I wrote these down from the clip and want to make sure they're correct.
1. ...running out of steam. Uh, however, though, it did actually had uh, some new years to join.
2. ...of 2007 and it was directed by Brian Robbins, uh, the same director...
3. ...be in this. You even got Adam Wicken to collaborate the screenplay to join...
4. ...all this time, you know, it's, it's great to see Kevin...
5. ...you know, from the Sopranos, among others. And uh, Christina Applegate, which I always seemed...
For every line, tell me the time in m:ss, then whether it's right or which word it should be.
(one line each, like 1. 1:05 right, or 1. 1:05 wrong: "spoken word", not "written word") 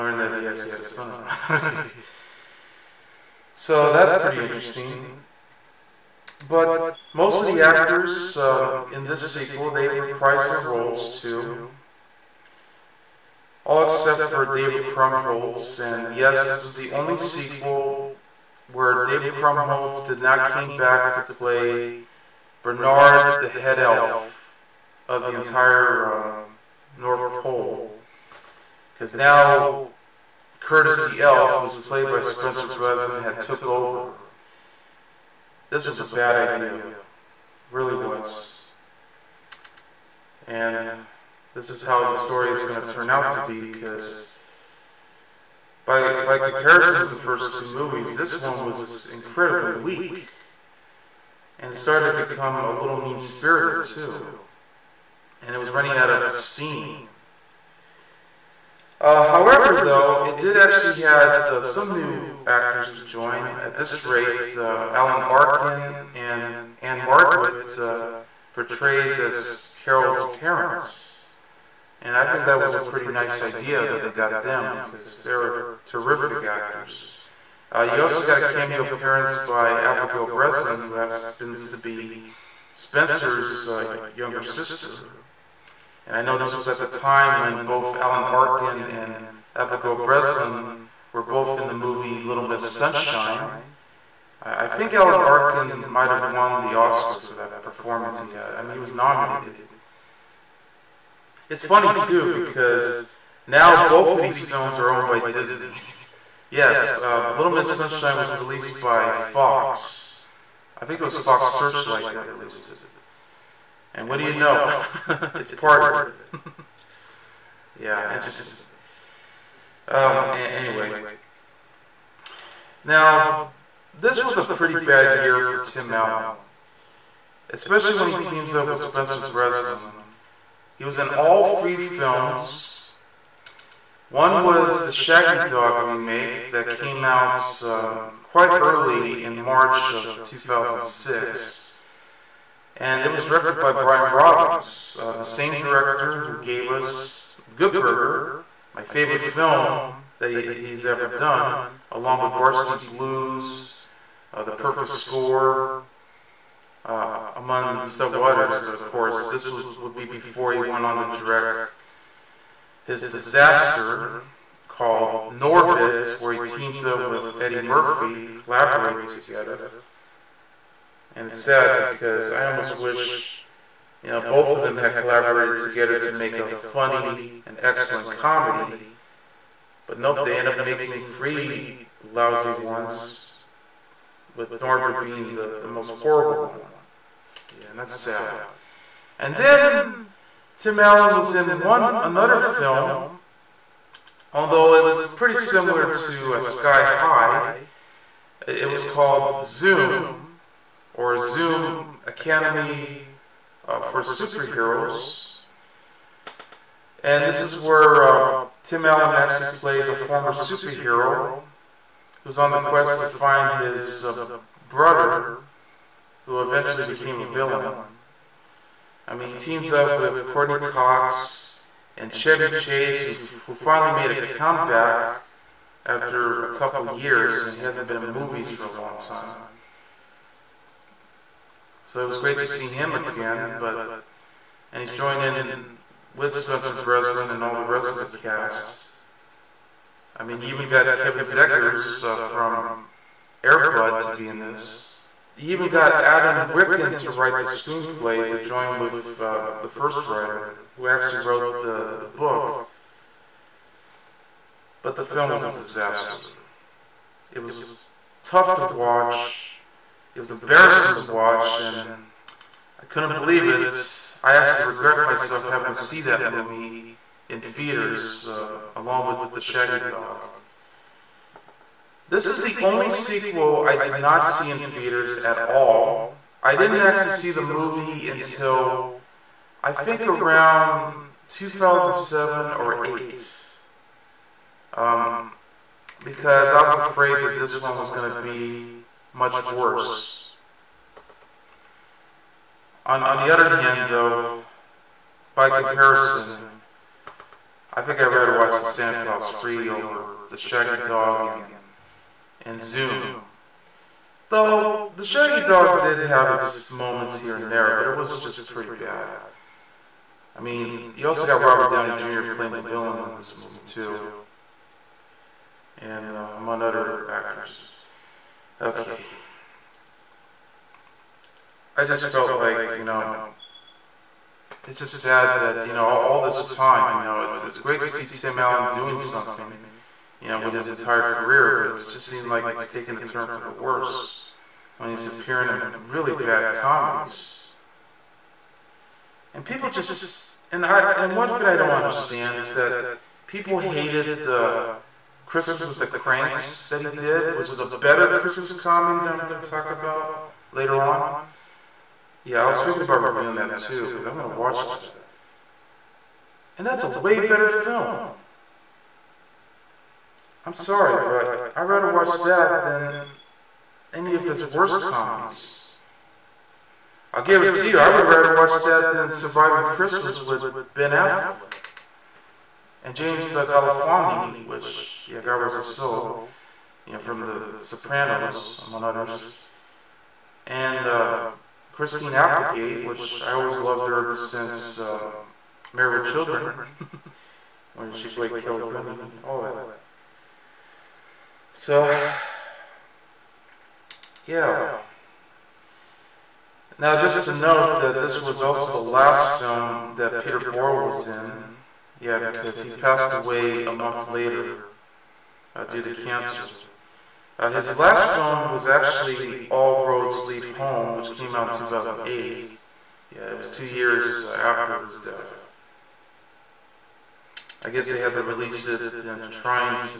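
1. 0:55 wrong: "actors", not "years"
2. 2:19 wrong: "2006", not "2007"
3. 4:04 wrong: "write", not "collaborate"
4. 5:25 wrong: "Tim", not "Kevin"
5. 6:16 wrong: "loved", not "seemed".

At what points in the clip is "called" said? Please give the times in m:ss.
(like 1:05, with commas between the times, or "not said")
2:44, 3:18.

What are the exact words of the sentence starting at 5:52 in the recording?
Yeah, I was thinking about reviewing that too, because I want to watch that.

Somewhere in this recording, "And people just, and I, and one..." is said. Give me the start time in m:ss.
5:39.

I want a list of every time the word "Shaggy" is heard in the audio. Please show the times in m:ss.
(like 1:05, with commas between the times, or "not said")
2:14, 4:29, 5:00, 5:05.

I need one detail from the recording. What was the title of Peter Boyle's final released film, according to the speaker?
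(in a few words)
All Roads Lead Home.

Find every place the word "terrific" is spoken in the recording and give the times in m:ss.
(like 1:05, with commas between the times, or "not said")
1:15.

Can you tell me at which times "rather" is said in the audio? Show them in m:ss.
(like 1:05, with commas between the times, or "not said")
4:58, 6:01, 6:08.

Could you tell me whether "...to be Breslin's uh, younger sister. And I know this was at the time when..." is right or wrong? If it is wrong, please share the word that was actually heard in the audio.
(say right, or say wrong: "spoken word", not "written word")
wrong: "Spencer", not "Breslin".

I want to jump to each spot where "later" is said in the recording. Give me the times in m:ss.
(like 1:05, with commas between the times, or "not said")
5:50, 6:44.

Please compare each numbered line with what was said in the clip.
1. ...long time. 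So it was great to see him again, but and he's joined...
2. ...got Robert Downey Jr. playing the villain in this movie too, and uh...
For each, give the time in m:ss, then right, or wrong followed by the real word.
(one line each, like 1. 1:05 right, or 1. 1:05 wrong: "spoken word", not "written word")
1. 3:48 right
2. 5:11 right.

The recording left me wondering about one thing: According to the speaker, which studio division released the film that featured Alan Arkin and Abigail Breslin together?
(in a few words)
Fox Searchlight.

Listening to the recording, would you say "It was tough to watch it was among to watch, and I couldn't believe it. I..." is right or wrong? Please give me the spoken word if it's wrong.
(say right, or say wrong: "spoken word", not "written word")
wrong: "embarrassing", not "among".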